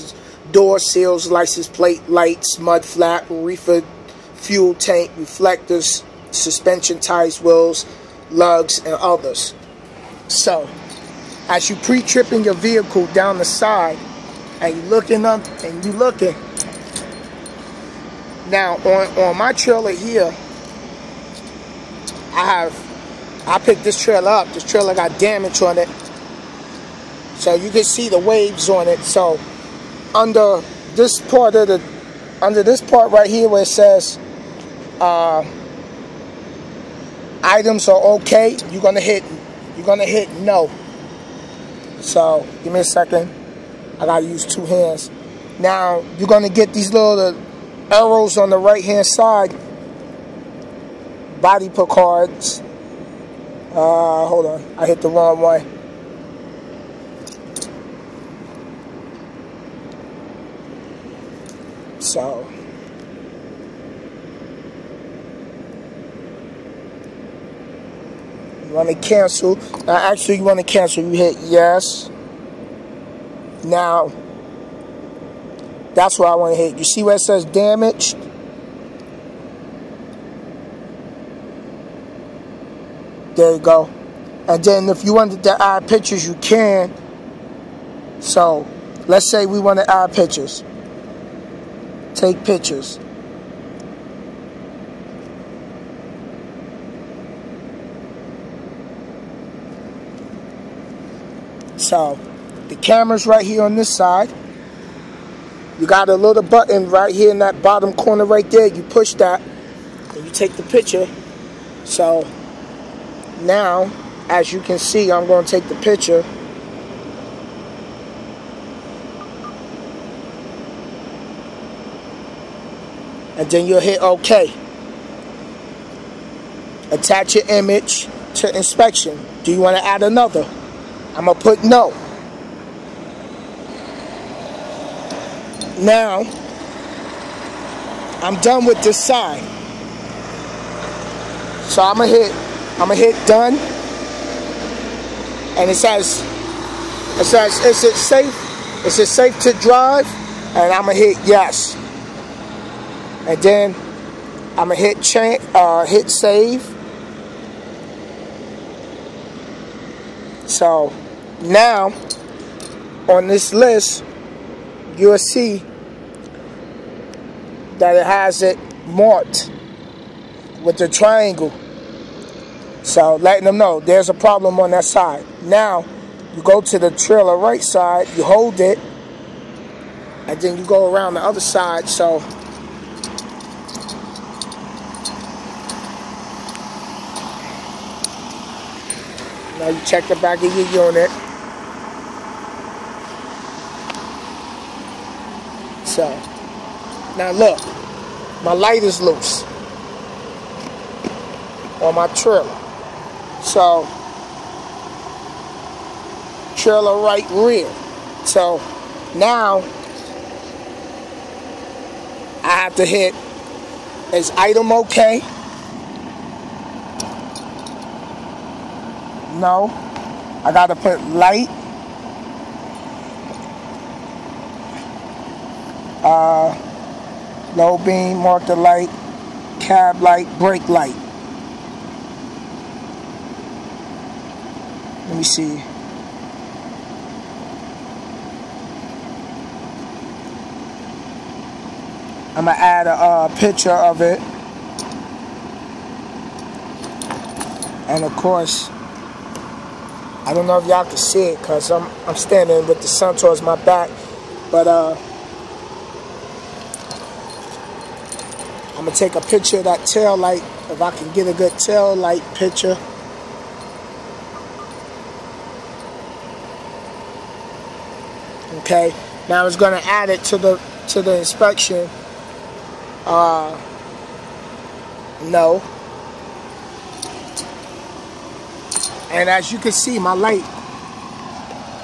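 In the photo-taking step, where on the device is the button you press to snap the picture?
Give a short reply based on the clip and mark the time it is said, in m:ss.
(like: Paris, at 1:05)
Bottom corner, at 1:47.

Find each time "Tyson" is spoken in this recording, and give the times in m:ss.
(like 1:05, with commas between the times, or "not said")
not said.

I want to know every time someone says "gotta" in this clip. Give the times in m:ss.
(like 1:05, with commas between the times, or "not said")
0:44, 3:40.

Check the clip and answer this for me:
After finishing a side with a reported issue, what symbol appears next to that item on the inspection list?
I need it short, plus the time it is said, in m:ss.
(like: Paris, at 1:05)
Triangle, at 2:50.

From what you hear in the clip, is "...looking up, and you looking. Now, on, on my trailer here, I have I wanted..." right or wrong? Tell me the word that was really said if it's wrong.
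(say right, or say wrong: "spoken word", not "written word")
wrong: "picked", not "wanted".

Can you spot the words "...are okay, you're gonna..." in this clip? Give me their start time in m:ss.
0:37.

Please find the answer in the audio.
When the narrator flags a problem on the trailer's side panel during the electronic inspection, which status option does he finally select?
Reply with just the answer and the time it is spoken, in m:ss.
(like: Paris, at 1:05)
Damaged, at 1:17.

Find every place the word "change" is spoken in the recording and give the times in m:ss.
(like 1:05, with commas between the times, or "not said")
2:35.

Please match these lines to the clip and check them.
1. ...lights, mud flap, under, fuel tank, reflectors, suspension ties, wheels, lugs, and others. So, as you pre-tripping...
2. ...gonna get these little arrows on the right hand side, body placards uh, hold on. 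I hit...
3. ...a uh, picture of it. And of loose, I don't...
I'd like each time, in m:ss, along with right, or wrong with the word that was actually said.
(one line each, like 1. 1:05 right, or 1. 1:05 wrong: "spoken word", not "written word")
1. 0:02 wrong: "reefer", not "under"
2. 0:46 right
3. 4:02 wrong: "course", not "loose".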